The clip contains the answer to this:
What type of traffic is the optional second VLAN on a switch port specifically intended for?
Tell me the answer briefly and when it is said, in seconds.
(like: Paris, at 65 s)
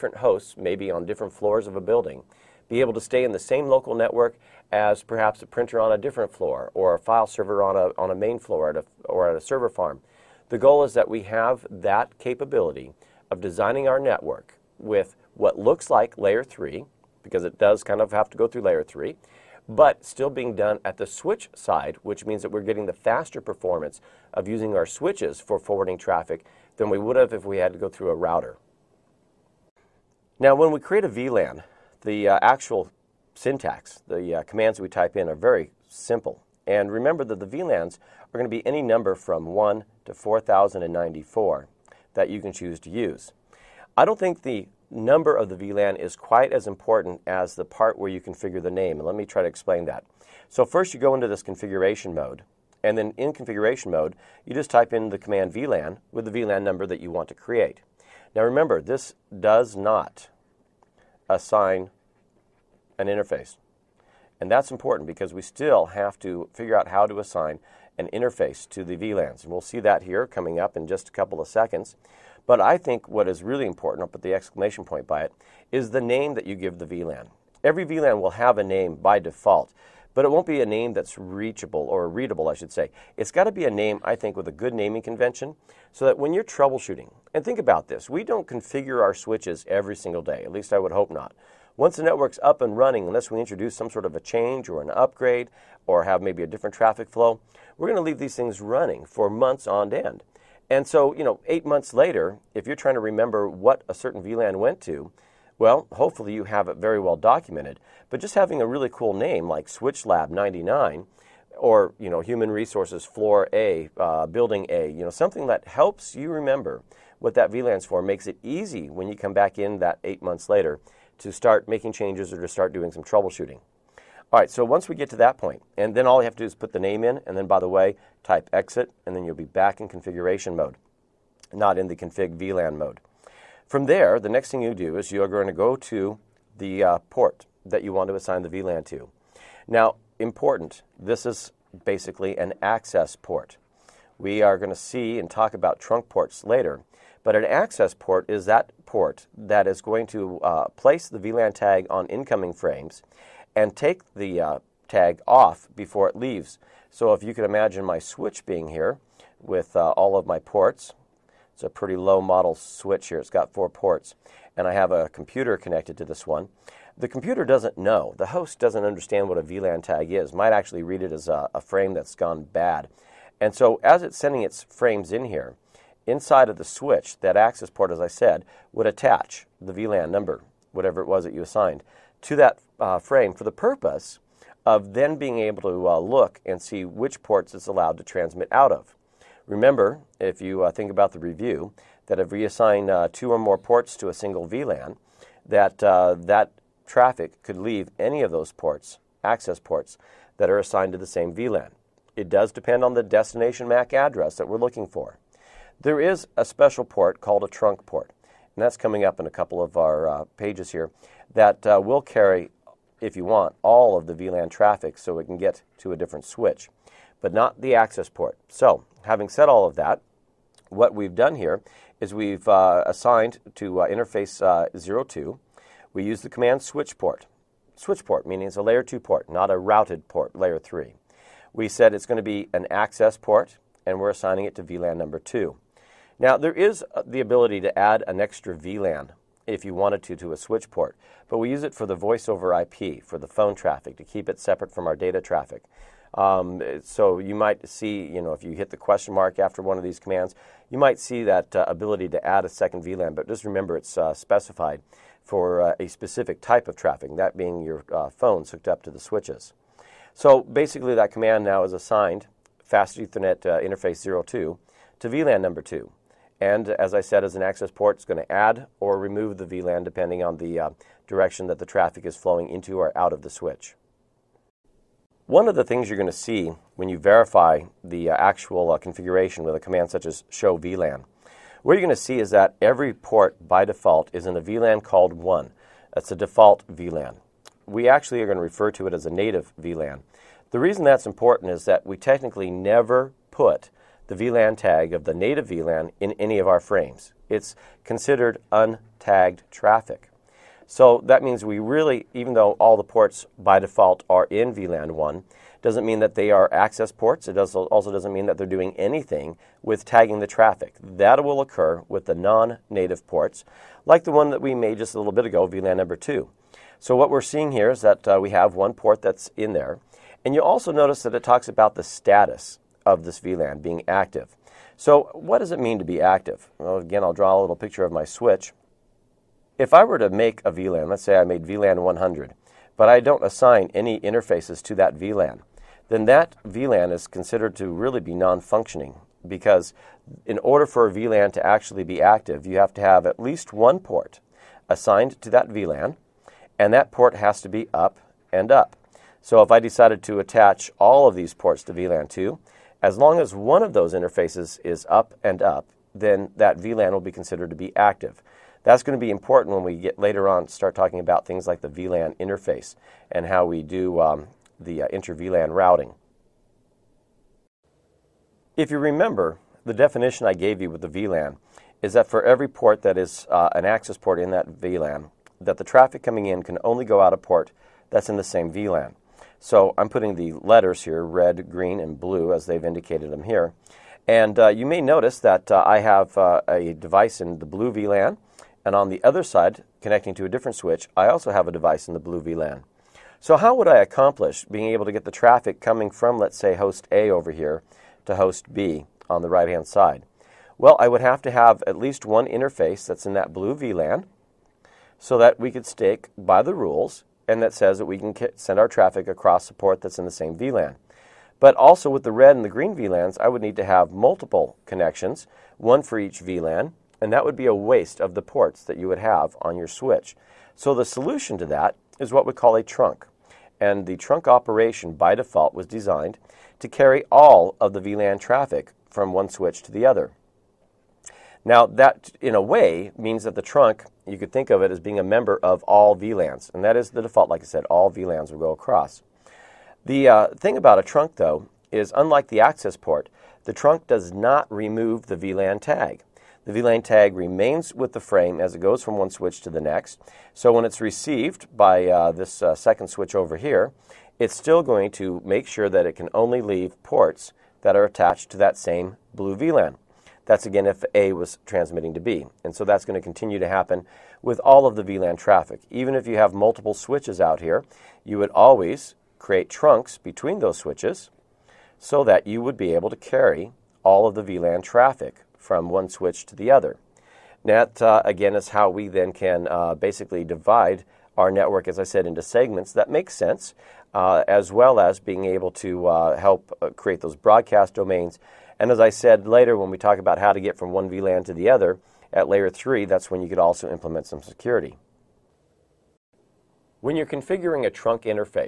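Voice over IP, at 241 s.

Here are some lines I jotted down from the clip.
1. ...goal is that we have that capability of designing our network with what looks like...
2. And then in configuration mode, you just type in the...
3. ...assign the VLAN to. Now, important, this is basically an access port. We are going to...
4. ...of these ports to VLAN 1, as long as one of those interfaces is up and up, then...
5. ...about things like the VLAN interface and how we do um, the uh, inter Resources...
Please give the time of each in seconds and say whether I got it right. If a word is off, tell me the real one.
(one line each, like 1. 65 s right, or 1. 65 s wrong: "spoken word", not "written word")
1. 10 s right
2. 52 s right
3. 138 s right
4. 351 s wrong: "2", not "1"
5. 360 s wrong: "VLAN", not "Resources".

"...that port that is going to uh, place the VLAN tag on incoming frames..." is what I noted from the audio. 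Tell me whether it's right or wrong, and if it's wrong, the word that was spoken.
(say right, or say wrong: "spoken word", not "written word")
right.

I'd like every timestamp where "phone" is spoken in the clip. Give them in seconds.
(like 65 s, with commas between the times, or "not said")
243 s, 258 s.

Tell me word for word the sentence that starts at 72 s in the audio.
But I think what is really important, I'll put the exclamation point by it, is the name that you give the VLAN.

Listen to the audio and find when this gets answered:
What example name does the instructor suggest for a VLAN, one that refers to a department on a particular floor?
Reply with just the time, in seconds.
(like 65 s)
112 s.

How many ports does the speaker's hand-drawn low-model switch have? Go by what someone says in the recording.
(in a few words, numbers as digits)
4.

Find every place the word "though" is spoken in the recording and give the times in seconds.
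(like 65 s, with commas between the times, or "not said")
302 s, 441 s.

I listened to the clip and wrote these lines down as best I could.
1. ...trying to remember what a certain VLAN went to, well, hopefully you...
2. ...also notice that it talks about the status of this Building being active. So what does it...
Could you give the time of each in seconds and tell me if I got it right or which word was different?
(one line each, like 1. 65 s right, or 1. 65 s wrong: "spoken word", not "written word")
1. 102 s right
2. 320 s wrong: "VLAN", not "Building".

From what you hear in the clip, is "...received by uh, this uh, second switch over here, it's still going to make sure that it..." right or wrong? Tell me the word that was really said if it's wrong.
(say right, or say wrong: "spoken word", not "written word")
right.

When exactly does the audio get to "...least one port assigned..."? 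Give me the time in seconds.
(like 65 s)
343 s.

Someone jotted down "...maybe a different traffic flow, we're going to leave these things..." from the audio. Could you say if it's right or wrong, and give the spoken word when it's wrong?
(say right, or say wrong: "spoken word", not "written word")
right.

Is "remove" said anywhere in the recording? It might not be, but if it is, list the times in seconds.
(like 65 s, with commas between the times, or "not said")
268 s, 444 s.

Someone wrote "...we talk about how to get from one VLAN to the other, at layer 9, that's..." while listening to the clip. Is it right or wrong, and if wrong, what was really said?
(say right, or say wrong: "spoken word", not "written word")
wrong: "3", not "9".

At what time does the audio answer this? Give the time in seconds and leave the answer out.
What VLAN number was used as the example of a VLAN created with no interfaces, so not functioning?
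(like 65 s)
331 s.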